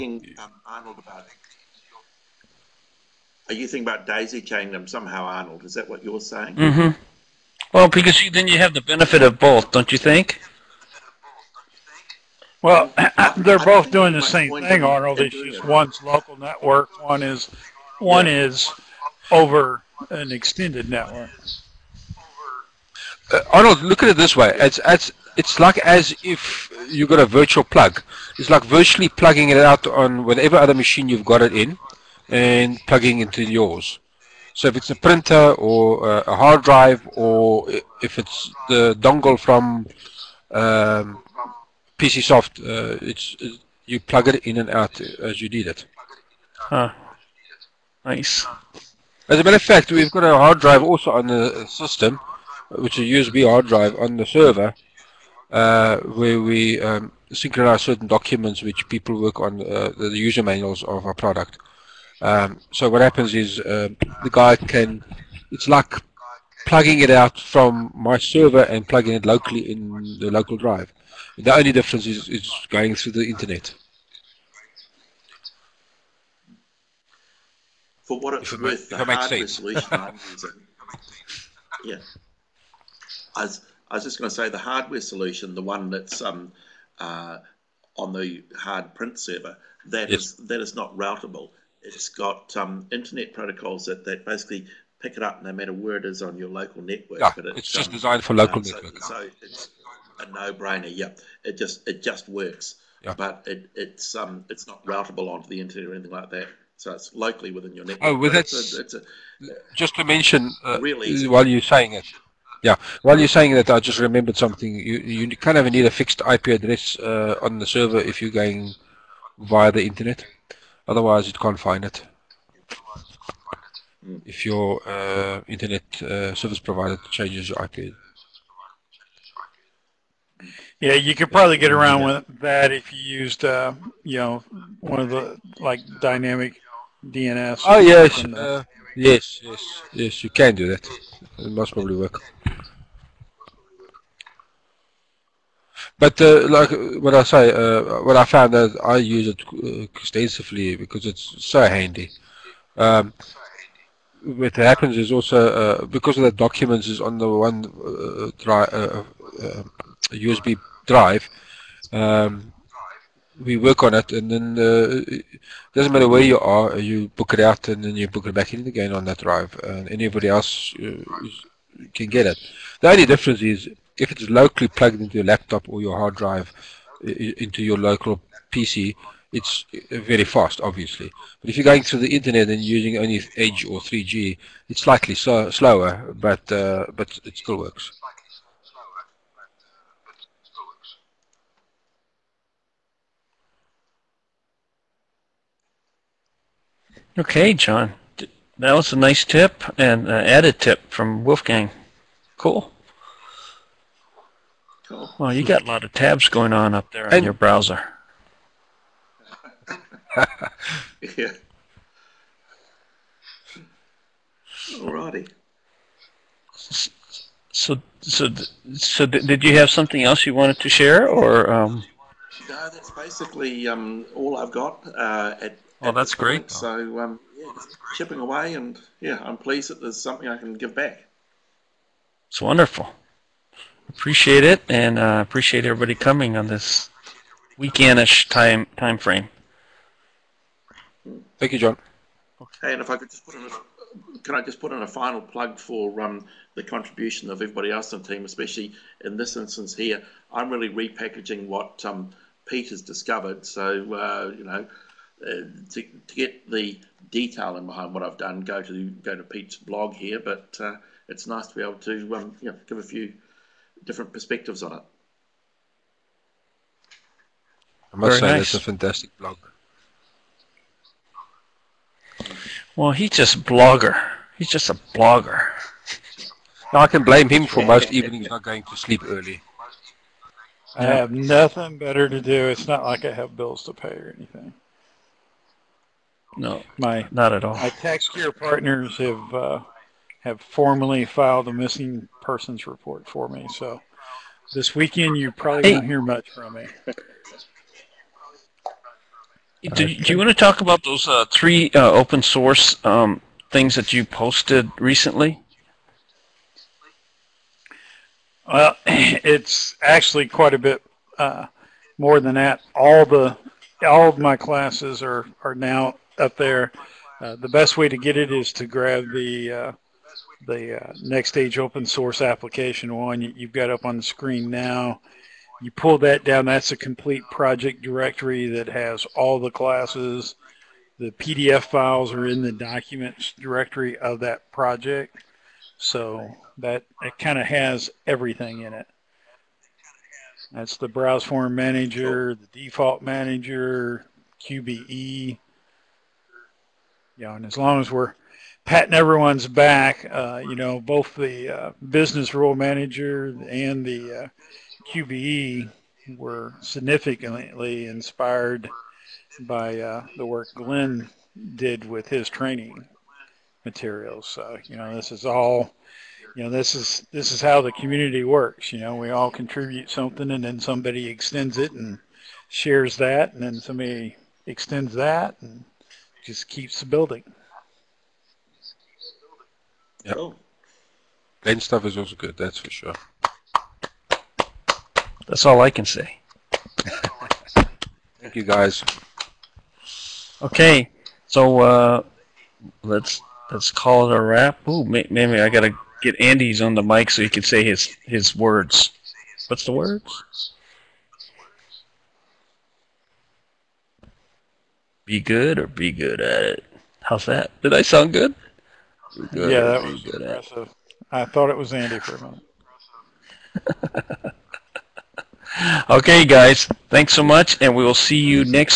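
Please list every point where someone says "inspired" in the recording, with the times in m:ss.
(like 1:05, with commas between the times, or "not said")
5:57.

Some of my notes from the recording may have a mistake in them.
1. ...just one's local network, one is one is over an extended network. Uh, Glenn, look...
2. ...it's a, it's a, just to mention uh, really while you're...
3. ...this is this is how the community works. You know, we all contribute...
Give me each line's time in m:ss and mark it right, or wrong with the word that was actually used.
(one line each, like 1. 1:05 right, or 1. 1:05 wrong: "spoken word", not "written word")
1. 0:15 wrong: "Arnold", not "Glenn"
2. 1:48 right
3. 6:06 right.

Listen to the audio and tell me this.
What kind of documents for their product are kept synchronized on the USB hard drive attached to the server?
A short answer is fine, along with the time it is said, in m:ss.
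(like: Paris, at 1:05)
user manuals, at 1:00.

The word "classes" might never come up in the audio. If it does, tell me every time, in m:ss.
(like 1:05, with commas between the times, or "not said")
5:14, 5:29.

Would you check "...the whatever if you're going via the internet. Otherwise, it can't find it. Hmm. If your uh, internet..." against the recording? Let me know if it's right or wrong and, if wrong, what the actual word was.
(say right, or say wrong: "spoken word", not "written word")
wrong: "server", not "whatever".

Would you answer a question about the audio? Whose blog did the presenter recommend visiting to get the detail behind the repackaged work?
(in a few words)
Pete.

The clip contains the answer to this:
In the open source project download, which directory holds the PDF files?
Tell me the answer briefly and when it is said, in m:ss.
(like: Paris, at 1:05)
documents directory, at 5:32.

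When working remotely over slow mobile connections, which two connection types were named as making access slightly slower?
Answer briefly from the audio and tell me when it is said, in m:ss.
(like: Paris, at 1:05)
Edge or 3G, at 3:03.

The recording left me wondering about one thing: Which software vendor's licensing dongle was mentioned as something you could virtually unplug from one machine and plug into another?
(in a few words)
PCSoft.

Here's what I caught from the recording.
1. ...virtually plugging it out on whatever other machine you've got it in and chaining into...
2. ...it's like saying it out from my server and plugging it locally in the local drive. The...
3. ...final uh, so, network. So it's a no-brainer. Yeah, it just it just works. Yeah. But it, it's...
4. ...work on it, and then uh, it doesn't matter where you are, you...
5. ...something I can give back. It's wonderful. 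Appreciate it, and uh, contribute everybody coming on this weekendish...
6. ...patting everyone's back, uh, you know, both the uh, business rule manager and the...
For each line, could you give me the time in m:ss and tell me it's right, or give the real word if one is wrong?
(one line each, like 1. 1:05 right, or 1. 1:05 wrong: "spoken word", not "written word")
1. 0:28 wrong: "plugging", not "chaining"
2. 1:05 wrong: "plugging", not "saying"
3. 1:38 wrong: "local", not "final"
4. 2:43 right
5. 3:50 wrong: "appreciate", not "contribute"
6. 5:48 right.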